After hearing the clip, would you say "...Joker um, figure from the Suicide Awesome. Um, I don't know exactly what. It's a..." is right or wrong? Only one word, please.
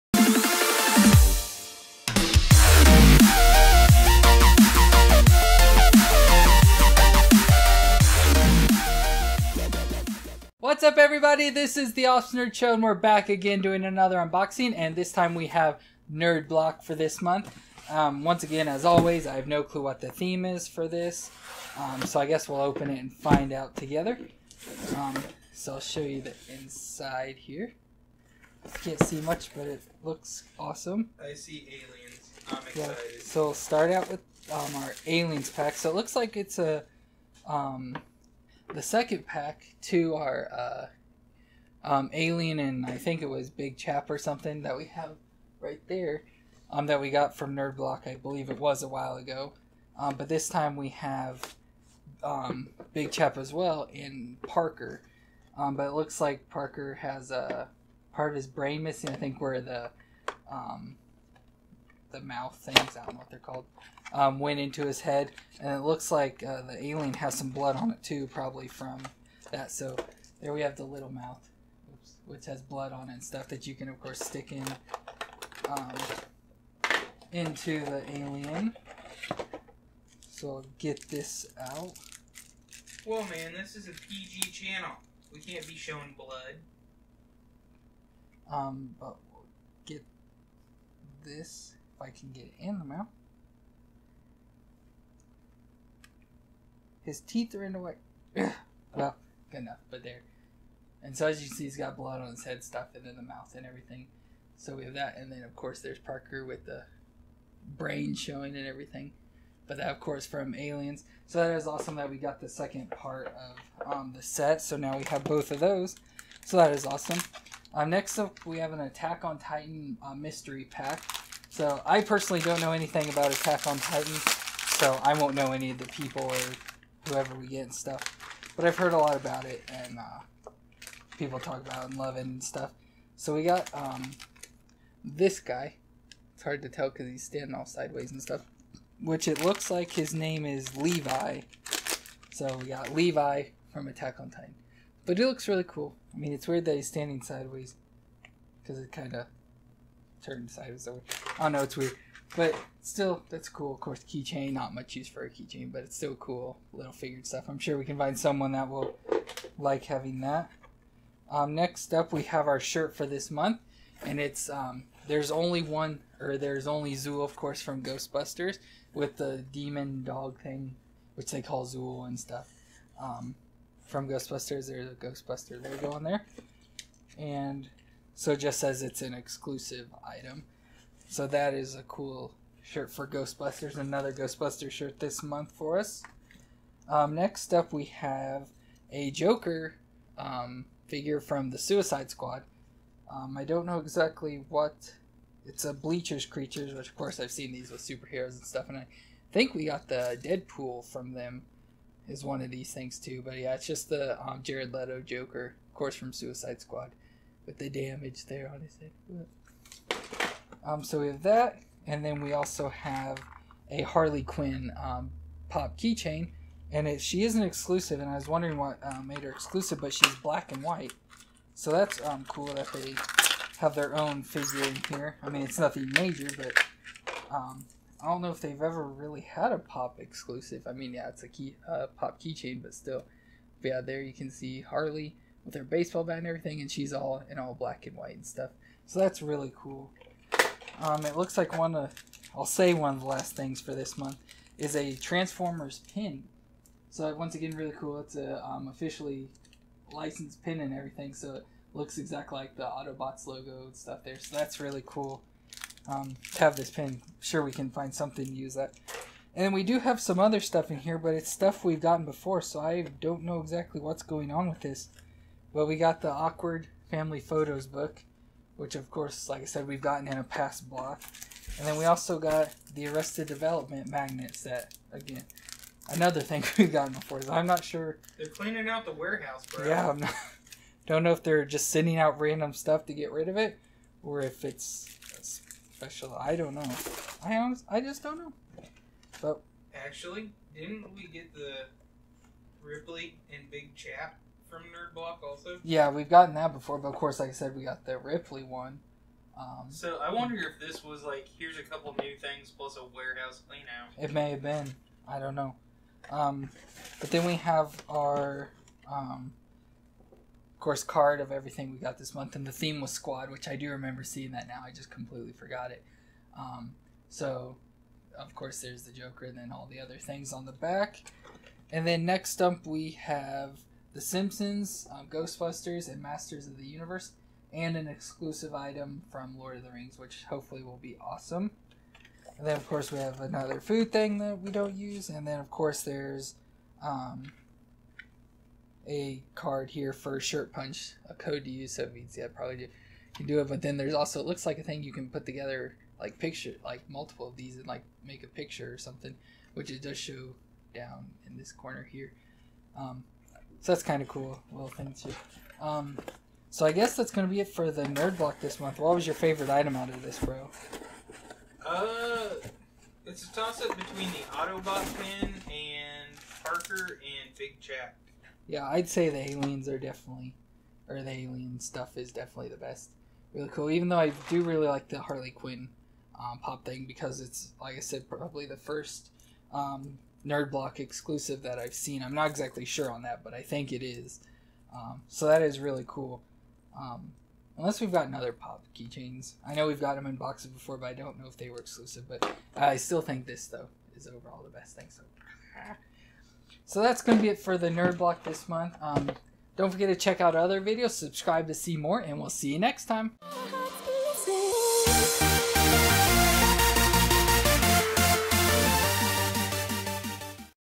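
wrong.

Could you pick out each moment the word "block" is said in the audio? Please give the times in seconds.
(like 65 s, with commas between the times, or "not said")
16 s, 47 s, 270 s, 294 s, 358 s, 380 s, 397 s.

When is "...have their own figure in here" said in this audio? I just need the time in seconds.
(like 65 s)
223 s.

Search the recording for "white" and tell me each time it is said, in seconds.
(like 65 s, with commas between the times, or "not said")
220 s, 237 s.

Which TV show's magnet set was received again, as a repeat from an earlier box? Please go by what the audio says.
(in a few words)
Arrested Development.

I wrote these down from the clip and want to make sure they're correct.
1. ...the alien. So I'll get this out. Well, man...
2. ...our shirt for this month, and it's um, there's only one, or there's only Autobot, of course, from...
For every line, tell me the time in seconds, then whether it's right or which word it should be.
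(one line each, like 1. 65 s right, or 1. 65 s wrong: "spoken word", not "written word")
1. 77 s right
2. 162 s wrong: "Zuul", not "Autobot".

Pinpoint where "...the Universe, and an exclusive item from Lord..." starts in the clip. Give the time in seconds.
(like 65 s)
326 s.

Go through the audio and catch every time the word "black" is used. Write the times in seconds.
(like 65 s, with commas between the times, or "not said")
220 s, 237 s.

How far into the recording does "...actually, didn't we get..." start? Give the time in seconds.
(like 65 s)
289 s.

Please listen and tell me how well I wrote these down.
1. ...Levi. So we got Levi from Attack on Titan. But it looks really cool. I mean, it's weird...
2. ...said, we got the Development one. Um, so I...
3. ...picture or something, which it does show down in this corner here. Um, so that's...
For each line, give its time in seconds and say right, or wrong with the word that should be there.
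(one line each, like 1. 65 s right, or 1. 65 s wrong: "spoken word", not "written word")
1. 140 s right
2. 297 s wrong: "Ripley", not "Development"
3. 348 s right.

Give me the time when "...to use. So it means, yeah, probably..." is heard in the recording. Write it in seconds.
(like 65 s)
341 s.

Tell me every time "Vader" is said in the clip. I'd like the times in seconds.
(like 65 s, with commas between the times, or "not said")
not said.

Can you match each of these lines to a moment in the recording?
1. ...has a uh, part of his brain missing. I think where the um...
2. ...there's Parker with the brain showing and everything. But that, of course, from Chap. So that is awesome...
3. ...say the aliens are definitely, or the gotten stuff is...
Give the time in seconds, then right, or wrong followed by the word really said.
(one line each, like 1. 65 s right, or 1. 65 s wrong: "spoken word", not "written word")
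1. 56 s right
2. 105 s wrong: "Aliens", not "Chap"
3. 368 s wrong: "alien", not "gotten".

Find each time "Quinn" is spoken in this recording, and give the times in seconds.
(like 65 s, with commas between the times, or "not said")
214 s, 375 s.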